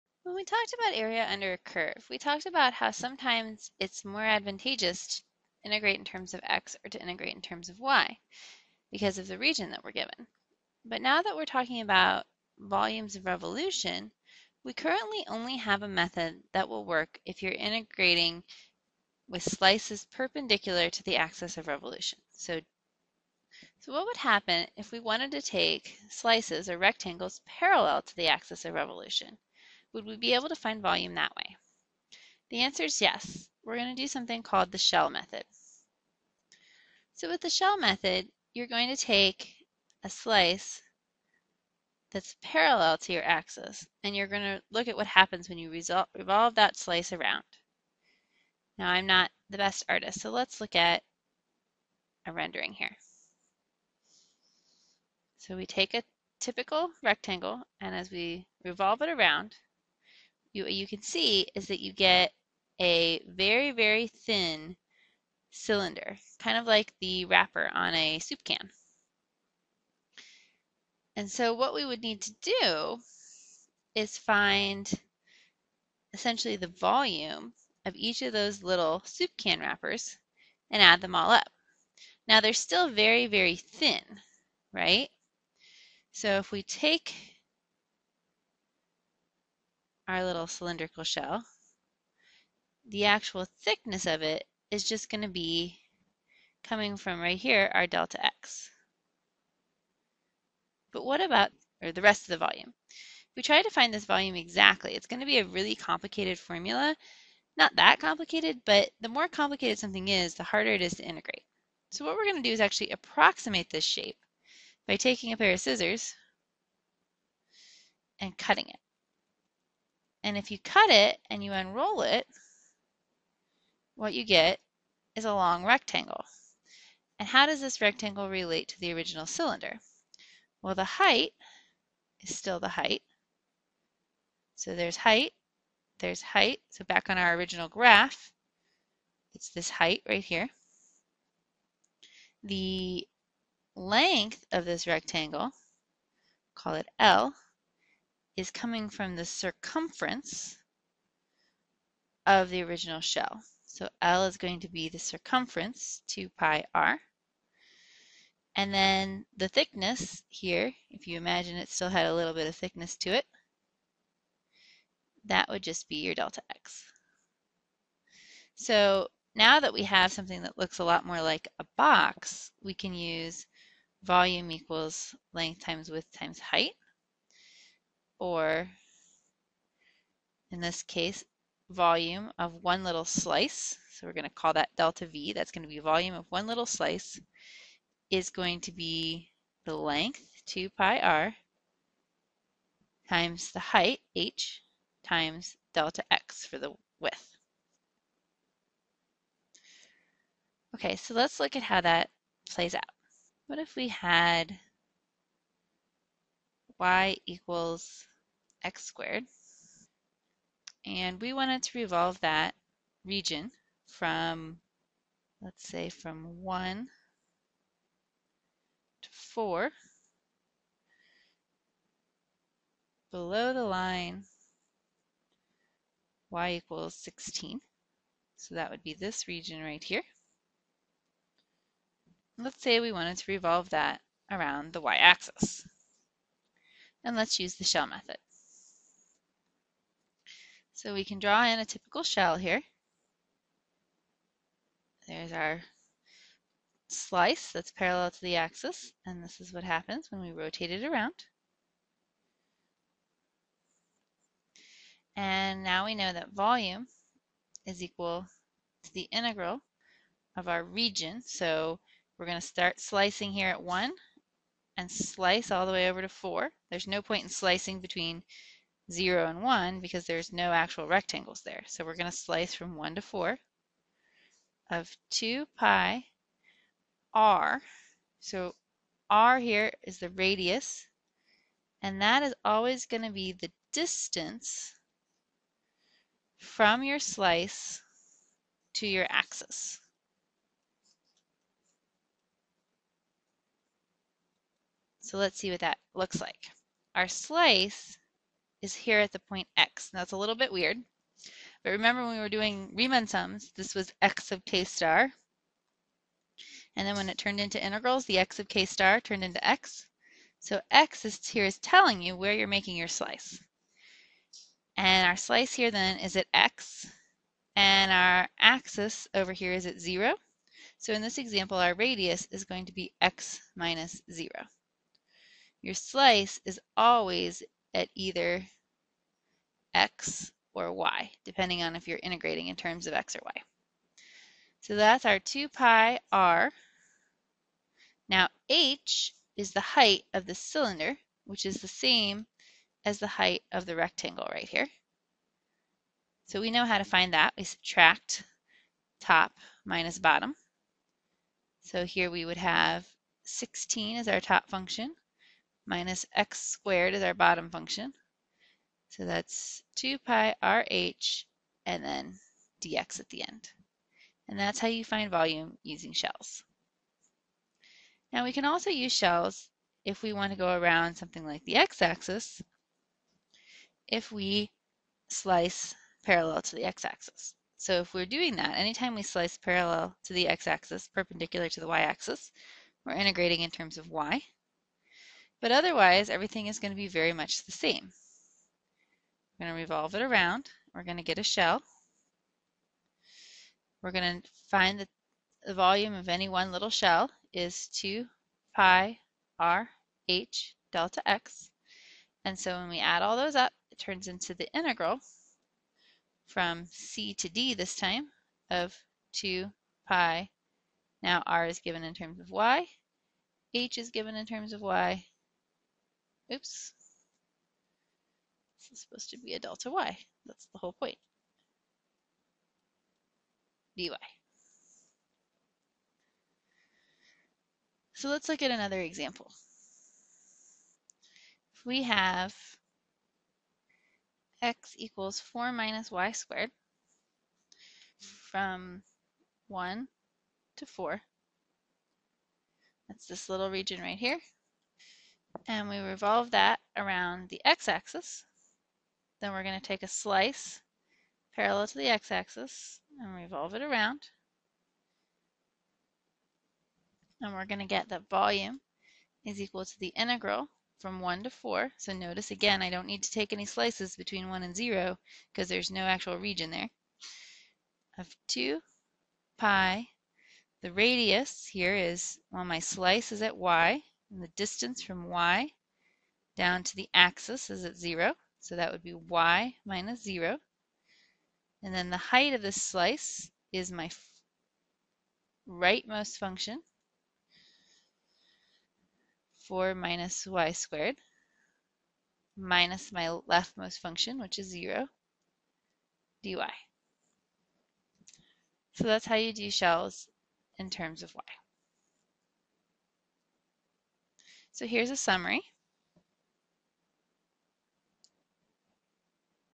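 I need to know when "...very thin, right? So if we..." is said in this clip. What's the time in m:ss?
1:23.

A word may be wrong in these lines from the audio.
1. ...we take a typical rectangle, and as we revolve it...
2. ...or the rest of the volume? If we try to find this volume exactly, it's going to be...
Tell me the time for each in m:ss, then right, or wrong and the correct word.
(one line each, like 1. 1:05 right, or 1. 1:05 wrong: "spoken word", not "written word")
1. 0:55 right
2. 1:41 right.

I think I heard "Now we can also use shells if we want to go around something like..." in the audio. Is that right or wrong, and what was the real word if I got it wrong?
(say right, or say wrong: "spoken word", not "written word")
right.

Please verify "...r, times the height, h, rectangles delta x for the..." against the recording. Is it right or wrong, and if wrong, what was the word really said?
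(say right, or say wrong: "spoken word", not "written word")
wrong: "times", not "rectangles".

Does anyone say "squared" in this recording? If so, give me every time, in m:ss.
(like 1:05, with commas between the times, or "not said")
3:28, 5:56, 7:16, 8:10.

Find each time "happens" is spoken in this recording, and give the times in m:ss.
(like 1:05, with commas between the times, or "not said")
0:24, 0:45, 4:09.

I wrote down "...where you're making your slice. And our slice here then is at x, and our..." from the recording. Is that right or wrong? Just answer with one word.
right.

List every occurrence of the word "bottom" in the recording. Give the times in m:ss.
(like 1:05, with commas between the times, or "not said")
5:49, 5:57.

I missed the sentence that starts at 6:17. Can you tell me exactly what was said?
So if we're doing that, anytime we slice parallel to the x-axis, perpendicular to the y-axis, we're integrating in terms of y.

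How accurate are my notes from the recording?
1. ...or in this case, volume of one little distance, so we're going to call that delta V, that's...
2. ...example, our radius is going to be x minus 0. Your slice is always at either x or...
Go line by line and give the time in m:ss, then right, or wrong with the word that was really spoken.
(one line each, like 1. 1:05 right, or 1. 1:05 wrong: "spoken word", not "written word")
1. 2:58 wrong: "slice", not "distance"
2. 5:21 right.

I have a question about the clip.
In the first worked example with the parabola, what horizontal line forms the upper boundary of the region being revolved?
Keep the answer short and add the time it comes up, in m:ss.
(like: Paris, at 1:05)
y = 16, at 3:46.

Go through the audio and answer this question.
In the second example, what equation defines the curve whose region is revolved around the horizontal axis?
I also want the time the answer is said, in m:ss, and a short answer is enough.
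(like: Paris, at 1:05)
x = 4 - y^2, at 7:14.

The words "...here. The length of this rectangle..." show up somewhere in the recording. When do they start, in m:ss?
2:20.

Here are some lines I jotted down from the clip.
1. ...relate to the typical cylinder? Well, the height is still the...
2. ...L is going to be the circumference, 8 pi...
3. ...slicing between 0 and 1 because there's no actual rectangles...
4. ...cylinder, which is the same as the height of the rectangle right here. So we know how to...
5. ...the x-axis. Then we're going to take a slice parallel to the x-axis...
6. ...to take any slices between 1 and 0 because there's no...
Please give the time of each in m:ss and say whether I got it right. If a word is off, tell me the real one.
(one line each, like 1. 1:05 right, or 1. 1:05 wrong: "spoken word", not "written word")
1. 2:08 wrong: "original", not "typical"
2. 2:34 wrong: "2", not "8"
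3. 4:27 right
4. 5:40 right
5. 7:27 right
6. 7:43 right.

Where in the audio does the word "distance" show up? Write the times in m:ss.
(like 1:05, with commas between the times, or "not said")
4:43, 7:54.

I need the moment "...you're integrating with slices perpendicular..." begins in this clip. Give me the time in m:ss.
0:17.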